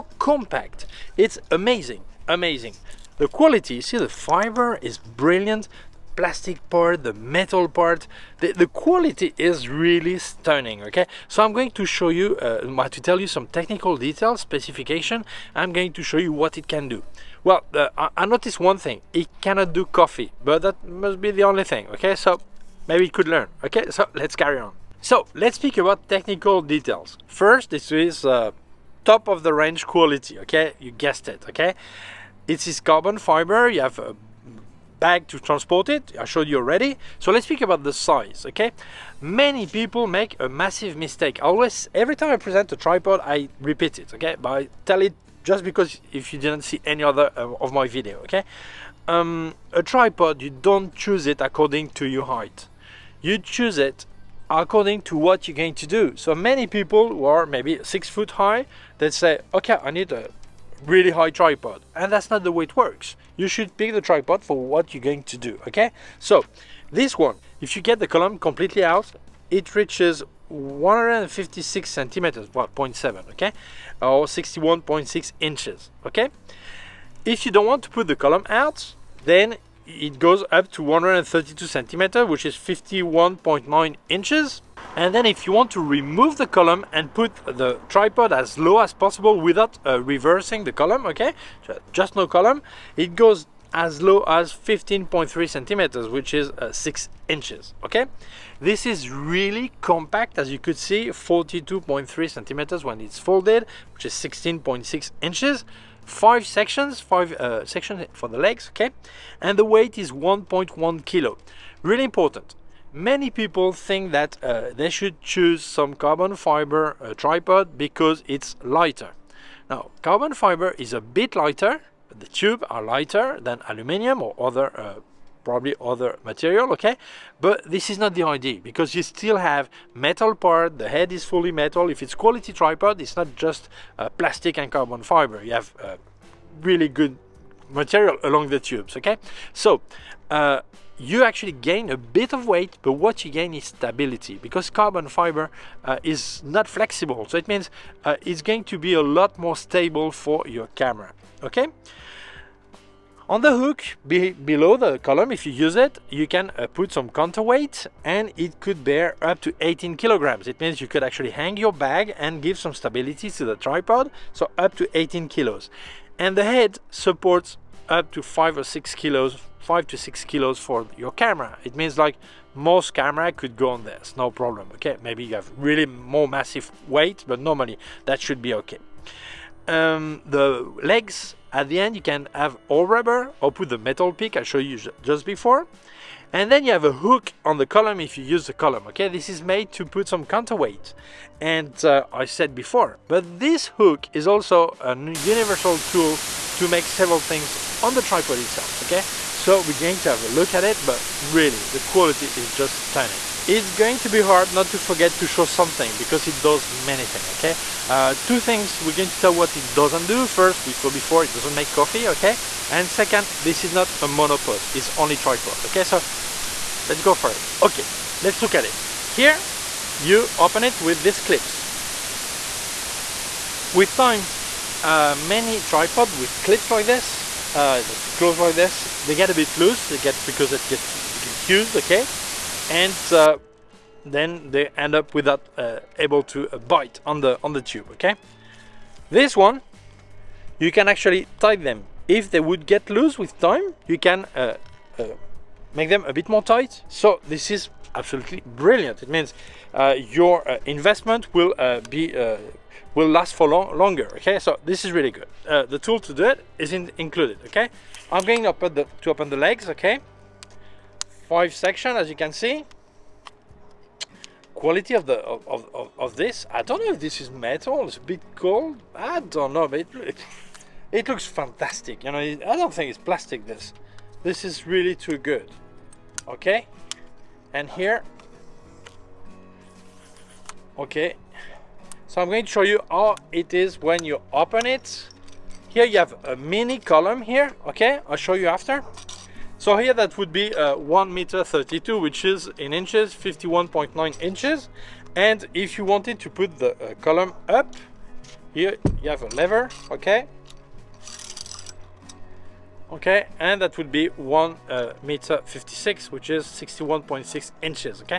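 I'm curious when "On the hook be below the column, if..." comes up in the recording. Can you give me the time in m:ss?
2:33.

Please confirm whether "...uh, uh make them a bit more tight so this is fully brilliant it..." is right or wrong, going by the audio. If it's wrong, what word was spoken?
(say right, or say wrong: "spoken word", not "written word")
wrong: "absolutely", not "fully".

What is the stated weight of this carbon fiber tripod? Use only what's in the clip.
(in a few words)
1.1 kilo.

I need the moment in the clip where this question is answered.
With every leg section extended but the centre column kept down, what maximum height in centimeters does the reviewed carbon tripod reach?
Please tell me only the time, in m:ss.
1:20.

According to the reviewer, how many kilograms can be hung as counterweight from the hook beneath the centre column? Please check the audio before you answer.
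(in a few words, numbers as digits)
18 kilograms.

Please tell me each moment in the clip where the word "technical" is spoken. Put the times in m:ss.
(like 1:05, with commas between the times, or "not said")
0:13, 0:26.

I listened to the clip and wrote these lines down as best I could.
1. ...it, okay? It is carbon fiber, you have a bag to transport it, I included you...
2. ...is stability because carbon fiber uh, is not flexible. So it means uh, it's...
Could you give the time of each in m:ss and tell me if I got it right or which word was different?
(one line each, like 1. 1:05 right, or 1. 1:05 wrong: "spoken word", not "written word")
1. 0:31 wrong: "showed", not "included"
2. 2:23 right.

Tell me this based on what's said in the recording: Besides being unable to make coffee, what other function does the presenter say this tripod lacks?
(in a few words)
monopod.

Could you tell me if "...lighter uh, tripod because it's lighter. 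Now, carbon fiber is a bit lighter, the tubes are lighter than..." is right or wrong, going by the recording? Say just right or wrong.
wrong.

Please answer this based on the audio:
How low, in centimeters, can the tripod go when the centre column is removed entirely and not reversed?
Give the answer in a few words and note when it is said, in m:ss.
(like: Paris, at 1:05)
15.3 centimeters, at 1:34.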